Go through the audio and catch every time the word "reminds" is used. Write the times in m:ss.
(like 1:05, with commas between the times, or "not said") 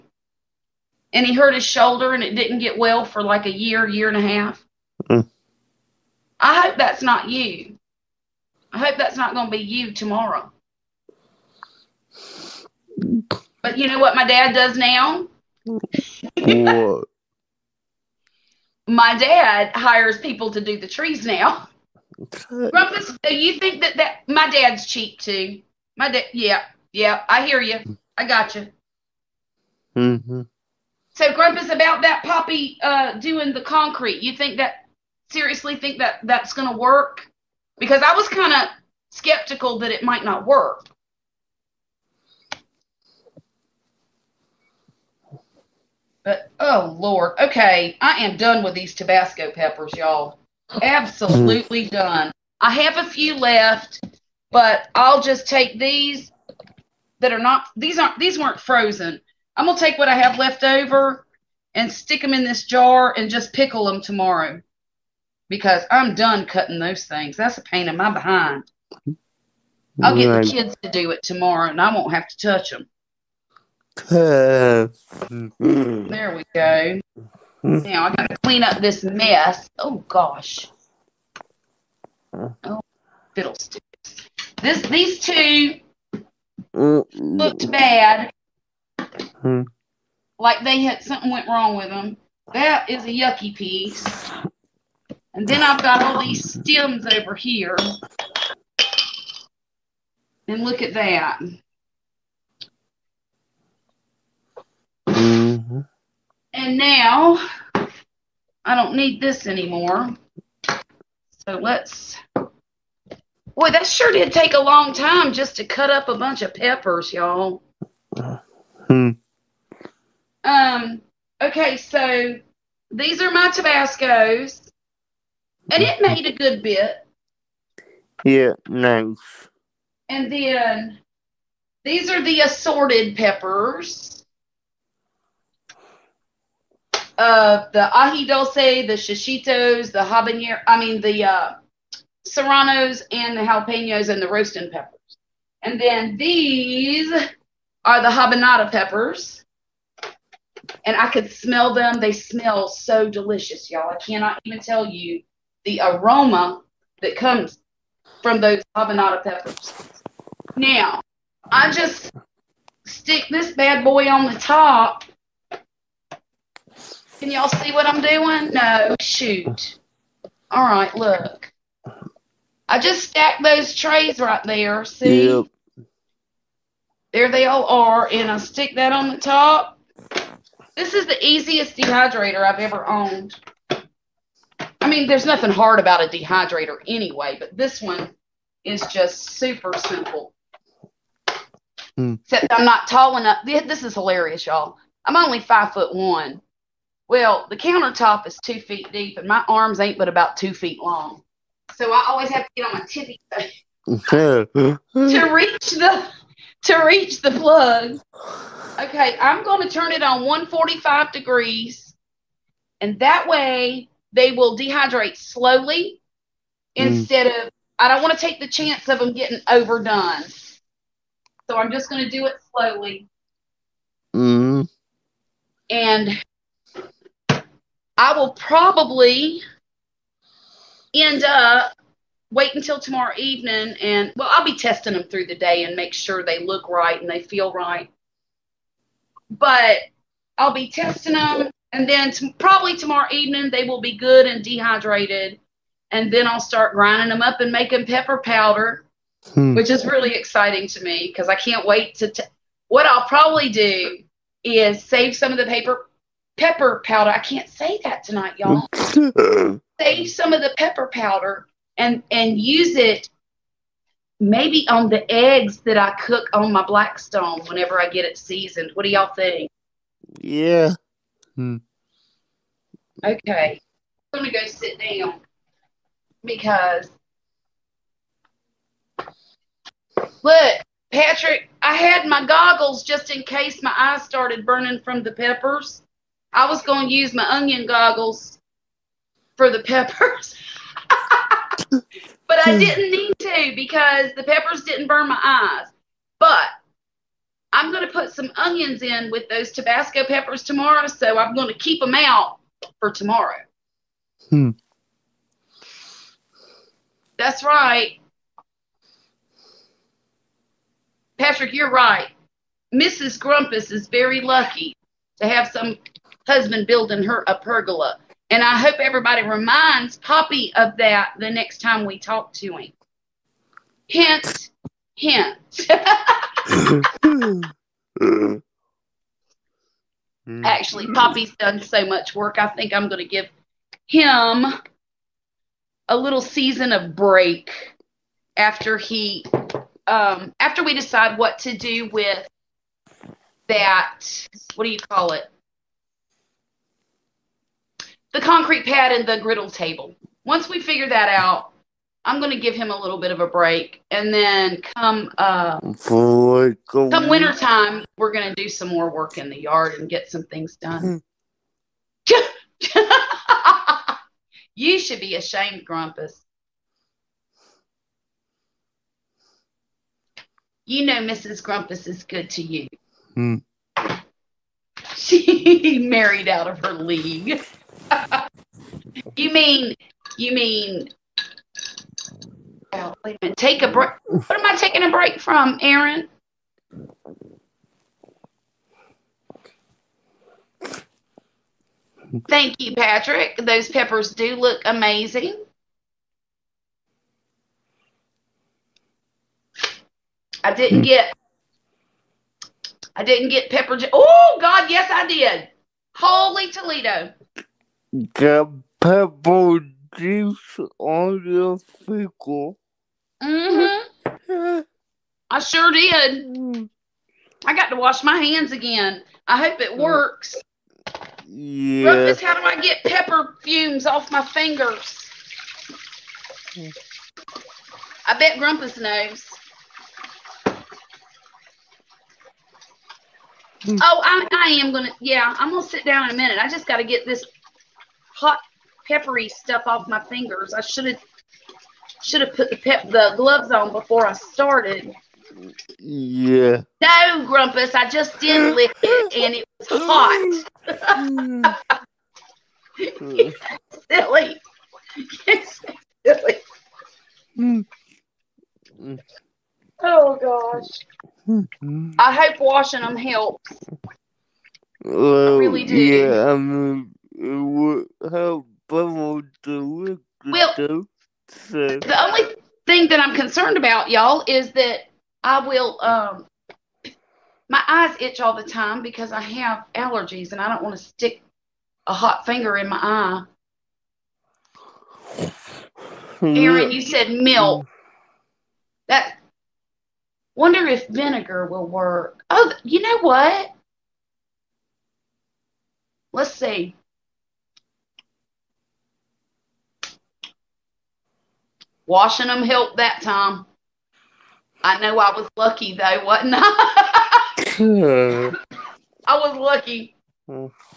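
5:19.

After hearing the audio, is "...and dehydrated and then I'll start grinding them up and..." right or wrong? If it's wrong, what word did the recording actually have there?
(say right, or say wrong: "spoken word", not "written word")
right.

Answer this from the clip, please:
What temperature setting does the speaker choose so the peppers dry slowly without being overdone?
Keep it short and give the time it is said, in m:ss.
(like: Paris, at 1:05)
145 degrees, at 3:30.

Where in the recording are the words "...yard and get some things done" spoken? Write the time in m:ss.
5:59.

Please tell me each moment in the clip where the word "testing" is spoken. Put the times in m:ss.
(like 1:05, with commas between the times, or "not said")
3:54, 4:00.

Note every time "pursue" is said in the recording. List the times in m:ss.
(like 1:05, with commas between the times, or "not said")
not said.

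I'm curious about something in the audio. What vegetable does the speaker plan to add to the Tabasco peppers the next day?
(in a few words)
Onions.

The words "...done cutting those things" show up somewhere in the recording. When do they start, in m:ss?
1:06.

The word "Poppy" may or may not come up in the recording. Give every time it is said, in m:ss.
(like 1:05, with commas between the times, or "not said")
0:32, 5:19, 5:30.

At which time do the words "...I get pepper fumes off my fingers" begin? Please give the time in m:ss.
7:02.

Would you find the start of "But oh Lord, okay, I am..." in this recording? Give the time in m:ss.
0:46.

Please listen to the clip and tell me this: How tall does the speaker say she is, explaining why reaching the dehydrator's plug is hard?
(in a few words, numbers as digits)
5 foot 1.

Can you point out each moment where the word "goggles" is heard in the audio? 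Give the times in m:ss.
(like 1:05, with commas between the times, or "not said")
4:42, 4:47.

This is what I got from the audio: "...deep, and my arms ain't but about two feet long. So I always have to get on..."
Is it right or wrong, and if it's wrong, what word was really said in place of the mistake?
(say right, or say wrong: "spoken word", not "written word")
right.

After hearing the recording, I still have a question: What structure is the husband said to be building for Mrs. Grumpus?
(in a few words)
A pergola.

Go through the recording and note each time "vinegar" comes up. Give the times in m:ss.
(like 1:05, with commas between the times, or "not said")
8:10.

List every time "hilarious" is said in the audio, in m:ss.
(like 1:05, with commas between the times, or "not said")
3:13.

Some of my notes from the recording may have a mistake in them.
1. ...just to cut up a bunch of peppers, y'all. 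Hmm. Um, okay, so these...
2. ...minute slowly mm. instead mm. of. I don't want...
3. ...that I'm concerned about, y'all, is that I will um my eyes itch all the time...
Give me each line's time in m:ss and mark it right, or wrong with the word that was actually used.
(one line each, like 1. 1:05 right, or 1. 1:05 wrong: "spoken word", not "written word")
1. 1:55 right
2. 3:34 wrong: "dehydrate", not "minute"
3. 7:52 right.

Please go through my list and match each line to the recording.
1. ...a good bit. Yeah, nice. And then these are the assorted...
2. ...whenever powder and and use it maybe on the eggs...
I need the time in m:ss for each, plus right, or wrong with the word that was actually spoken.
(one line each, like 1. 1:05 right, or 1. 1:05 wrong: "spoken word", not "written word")
1. 2:06 right
2. 4:20 wrong: "pepper", not "whenever".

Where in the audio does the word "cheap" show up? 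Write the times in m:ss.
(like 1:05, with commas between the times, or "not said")
0:24.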